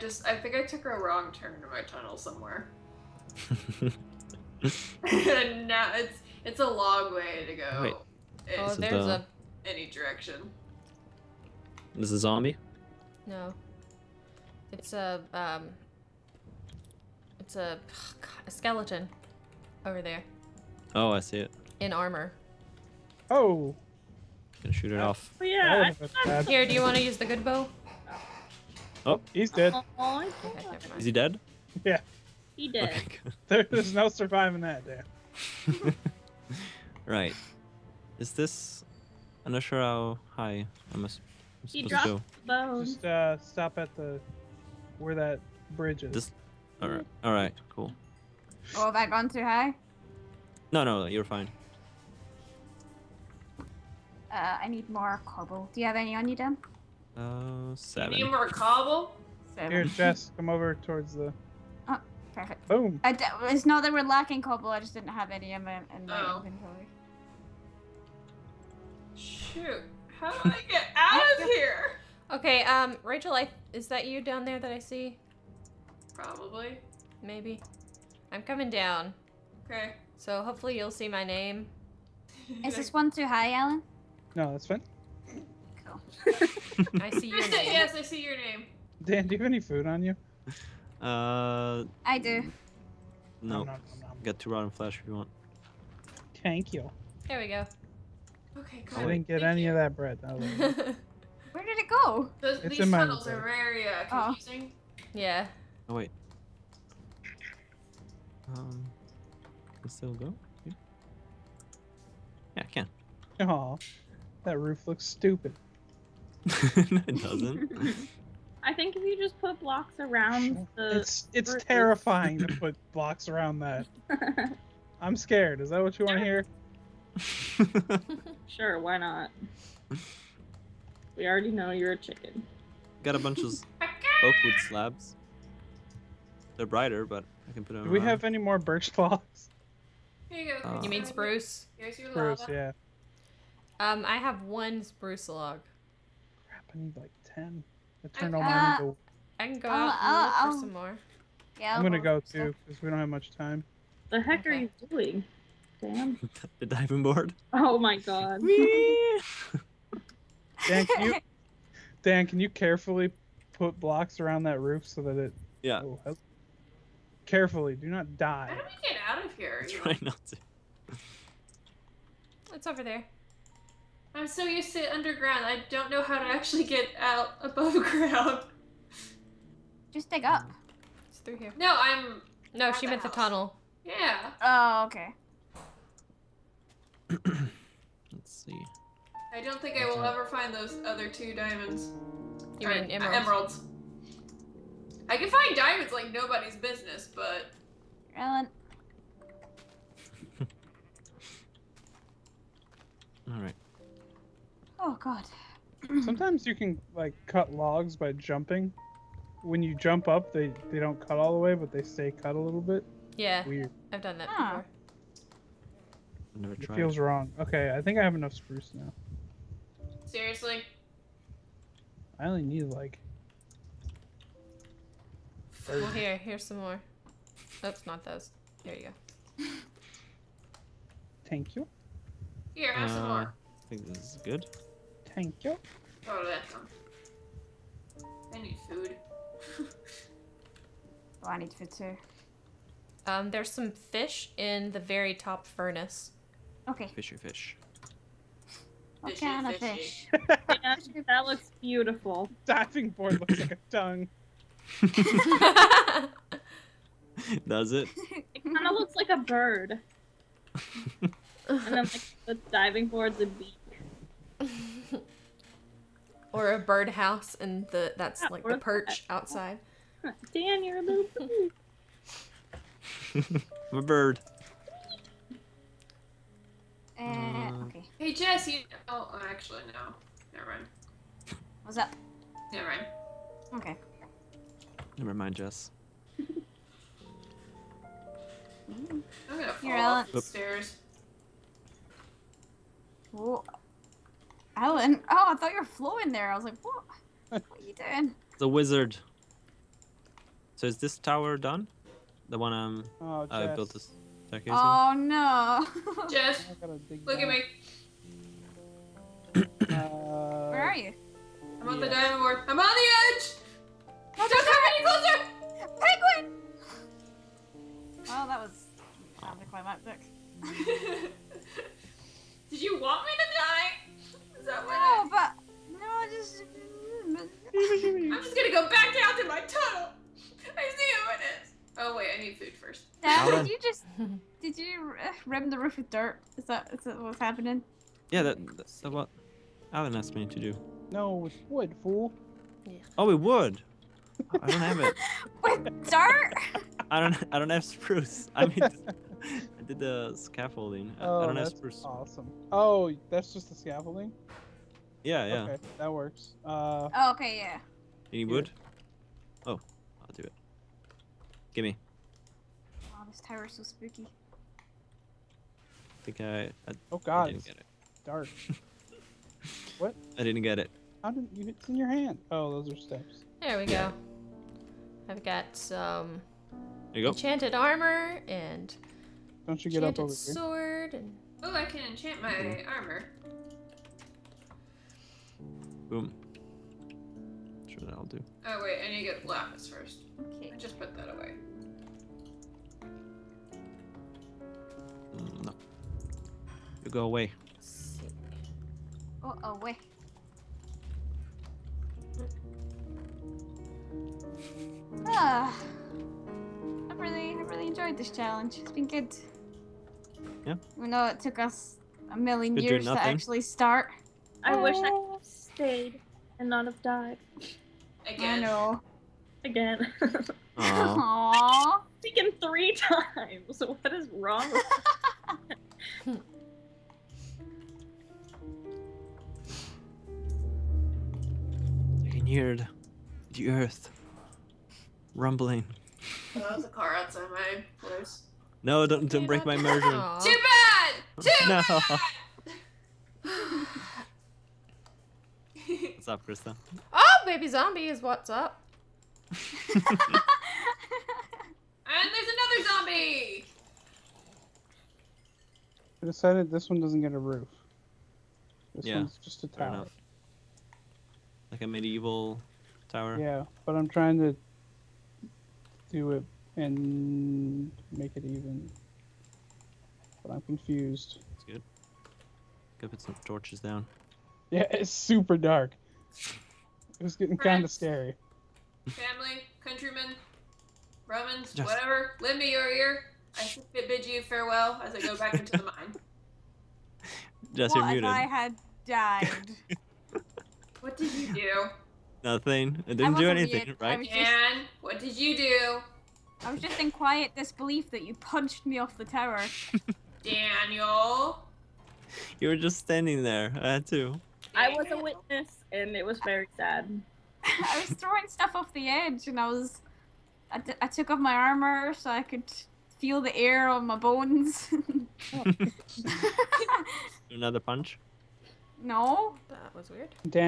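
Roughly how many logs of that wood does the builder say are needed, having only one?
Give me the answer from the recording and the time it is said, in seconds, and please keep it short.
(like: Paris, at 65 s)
10, at 146 s.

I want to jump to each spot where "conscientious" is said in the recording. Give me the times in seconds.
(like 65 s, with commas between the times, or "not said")
not said.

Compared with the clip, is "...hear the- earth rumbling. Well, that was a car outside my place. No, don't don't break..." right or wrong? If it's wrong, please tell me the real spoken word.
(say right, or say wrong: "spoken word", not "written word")
right.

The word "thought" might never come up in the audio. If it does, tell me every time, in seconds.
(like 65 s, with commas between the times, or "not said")
295 s.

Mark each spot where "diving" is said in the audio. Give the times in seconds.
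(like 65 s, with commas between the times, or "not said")
156 s, 252 s, 262 s.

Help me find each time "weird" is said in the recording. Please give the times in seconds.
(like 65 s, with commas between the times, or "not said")
213 s, 519 s.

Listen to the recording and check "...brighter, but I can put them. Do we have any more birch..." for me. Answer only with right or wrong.
right.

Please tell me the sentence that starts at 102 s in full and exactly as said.
Those, it's these tunnels are very uh, oh.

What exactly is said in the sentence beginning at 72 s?
Okay, um, Rachel, I is that you down there that I see?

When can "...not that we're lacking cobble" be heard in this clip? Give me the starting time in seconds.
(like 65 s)
63 s.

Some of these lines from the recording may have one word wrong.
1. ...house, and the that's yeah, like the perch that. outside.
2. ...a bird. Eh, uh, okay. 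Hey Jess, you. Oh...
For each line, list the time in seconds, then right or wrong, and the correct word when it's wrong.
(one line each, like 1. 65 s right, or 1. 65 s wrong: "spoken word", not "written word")
1. 266 s wrong: "birdhouse", not "house"
2. 273 s right.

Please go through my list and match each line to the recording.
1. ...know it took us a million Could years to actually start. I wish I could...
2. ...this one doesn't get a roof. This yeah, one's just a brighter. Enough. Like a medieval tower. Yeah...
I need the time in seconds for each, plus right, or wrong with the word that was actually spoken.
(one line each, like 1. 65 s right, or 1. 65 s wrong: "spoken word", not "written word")
1. 410 s right
2. 456 s wrong: "tower", not "brighter".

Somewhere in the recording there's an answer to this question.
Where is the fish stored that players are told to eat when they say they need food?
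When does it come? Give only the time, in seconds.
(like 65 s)
244 s.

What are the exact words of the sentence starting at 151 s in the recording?
Yeah, I'm gonna go too because we don't have much time.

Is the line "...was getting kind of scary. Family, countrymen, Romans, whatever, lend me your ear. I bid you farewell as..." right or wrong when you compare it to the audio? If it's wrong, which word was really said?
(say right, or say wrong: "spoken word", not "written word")
right.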